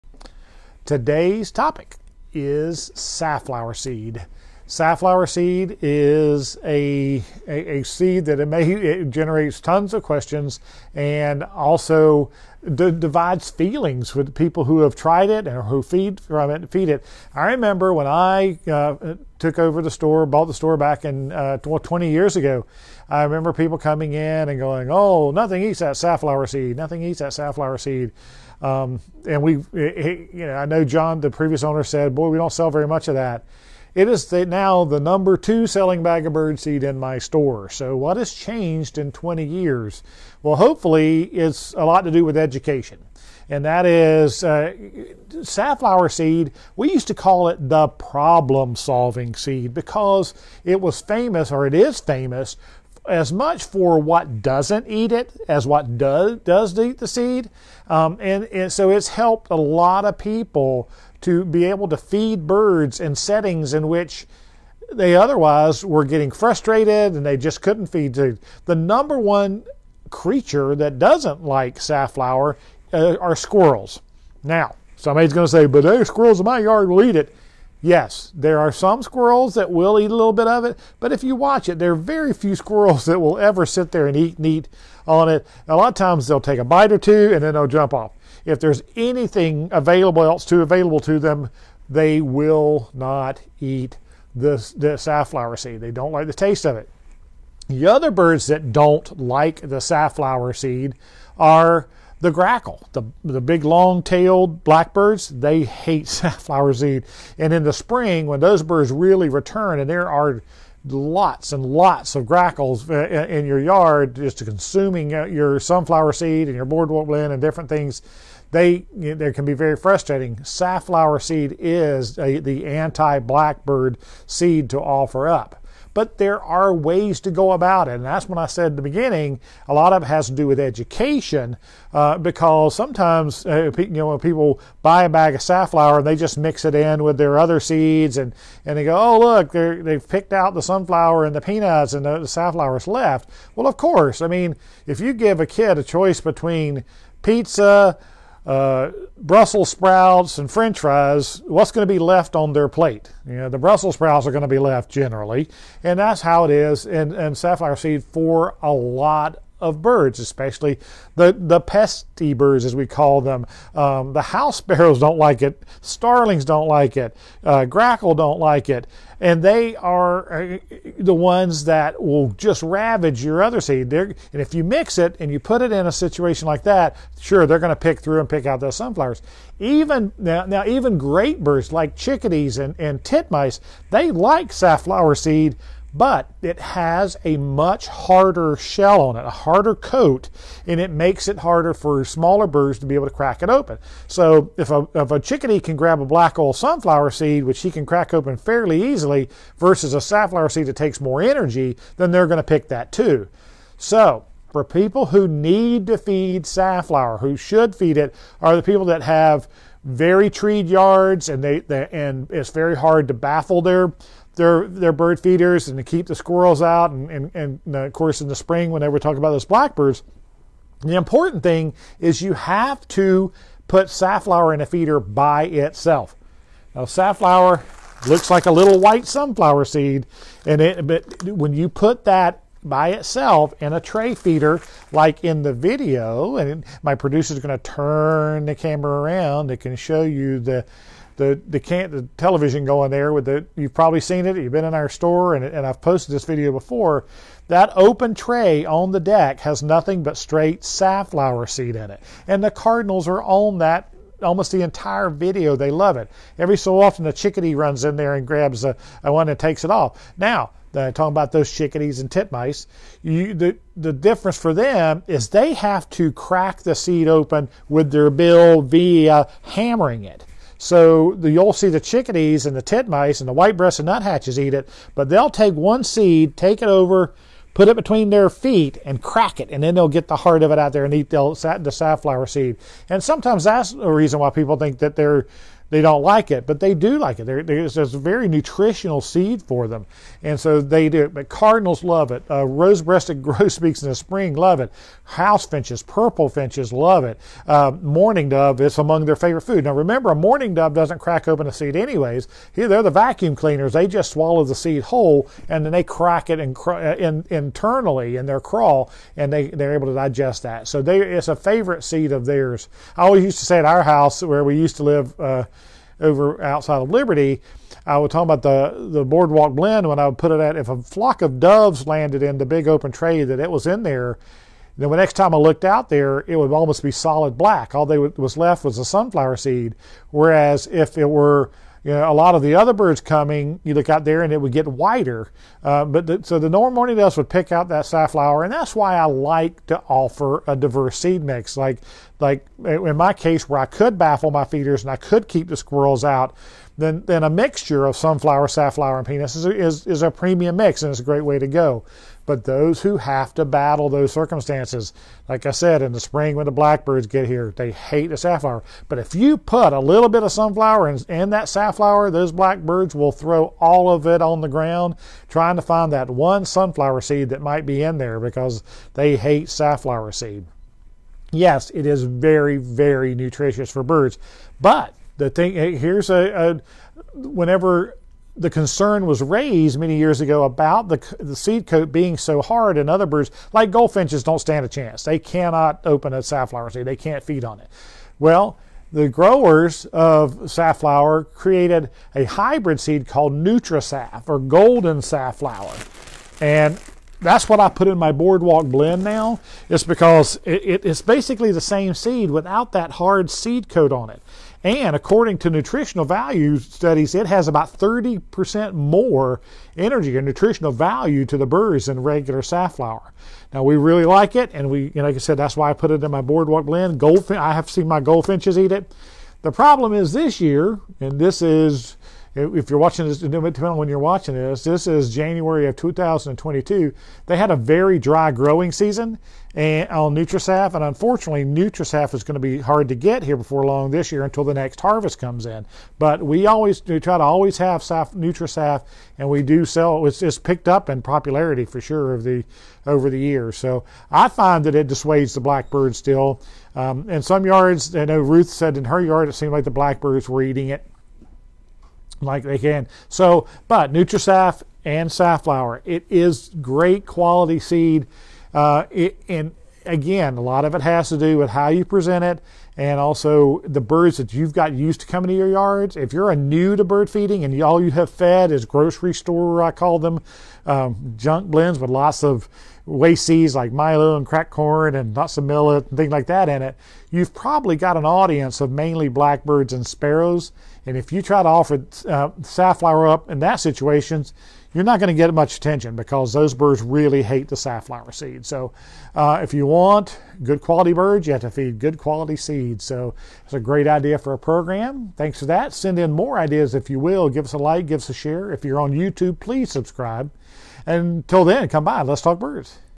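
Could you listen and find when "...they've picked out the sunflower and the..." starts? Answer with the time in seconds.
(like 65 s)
139 s.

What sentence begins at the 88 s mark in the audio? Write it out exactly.
If there's anything available else to available to them, they will not eat the, the safflower seed.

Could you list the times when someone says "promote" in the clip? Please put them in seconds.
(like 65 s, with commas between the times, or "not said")
not said.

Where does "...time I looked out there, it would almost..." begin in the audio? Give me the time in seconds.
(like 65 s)
325 s.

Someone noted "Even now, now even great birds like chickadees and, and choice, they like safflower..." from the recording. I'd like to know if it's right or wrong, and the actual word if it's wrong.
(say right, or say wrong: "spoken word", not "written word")
wrong: "titmice", not "choice".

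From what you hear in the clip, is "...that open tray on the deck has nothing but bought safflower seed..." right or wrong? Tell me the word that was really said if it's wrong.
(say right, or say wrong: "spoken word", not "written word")
wrong: "straight", not "bought".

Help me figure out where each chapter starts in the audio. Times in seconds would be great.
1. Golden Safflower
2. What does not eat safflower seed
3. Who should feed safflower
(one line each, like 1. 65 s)
1. 370 s
2. 45 s
3. 220 s.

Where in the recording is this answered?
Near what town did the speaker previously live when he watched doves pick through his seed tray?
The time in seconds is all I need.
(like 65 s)
316 s.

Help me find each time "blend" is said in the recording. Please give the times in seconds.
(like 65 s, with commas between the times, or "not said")
117 s, 319 s, 398 s, 416 s, 471 s.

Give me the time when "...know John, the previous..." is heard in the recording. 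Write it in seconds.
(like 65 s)
30 s.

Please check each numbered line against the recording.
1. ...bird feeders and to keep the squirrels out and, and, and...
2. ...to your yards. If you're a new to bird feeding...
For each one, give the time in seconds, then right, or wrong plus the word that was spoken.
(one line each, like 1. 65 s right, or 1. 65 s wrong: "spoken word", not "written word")
1. 214 s right
2. 465 s right.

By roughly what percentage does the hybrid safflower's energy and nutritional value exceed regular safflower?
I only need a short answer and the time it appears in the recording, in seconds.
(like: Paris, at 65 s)
30%, at 407 s.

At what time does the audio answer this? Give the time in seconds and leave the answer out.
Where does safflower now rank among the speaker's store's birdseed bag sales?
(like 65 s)
35 s.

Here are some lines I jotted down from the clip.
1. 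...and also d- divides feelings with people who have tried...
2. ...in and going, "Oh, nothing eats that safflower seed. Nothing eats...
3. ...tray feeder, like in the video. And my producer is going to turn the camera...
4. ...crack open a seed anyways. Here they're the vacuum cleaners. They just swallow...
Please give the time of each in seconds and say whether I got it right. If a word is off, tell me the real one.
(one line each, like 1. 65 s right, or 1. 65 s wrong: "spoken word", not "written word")
1. 10 s right
2. 24 s right
3. 233 s right
4. 300 s right.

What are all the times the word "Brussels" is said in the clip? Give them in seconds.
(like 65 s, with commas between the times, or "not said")
149 s, 153 s.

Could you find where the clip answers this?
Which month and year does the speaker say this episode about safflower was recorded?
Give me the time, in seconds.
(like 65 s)
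425 s.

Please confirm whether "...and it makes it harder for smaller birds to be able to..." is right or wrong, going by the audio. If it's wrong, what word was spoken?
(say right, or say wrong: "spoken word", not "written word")
right.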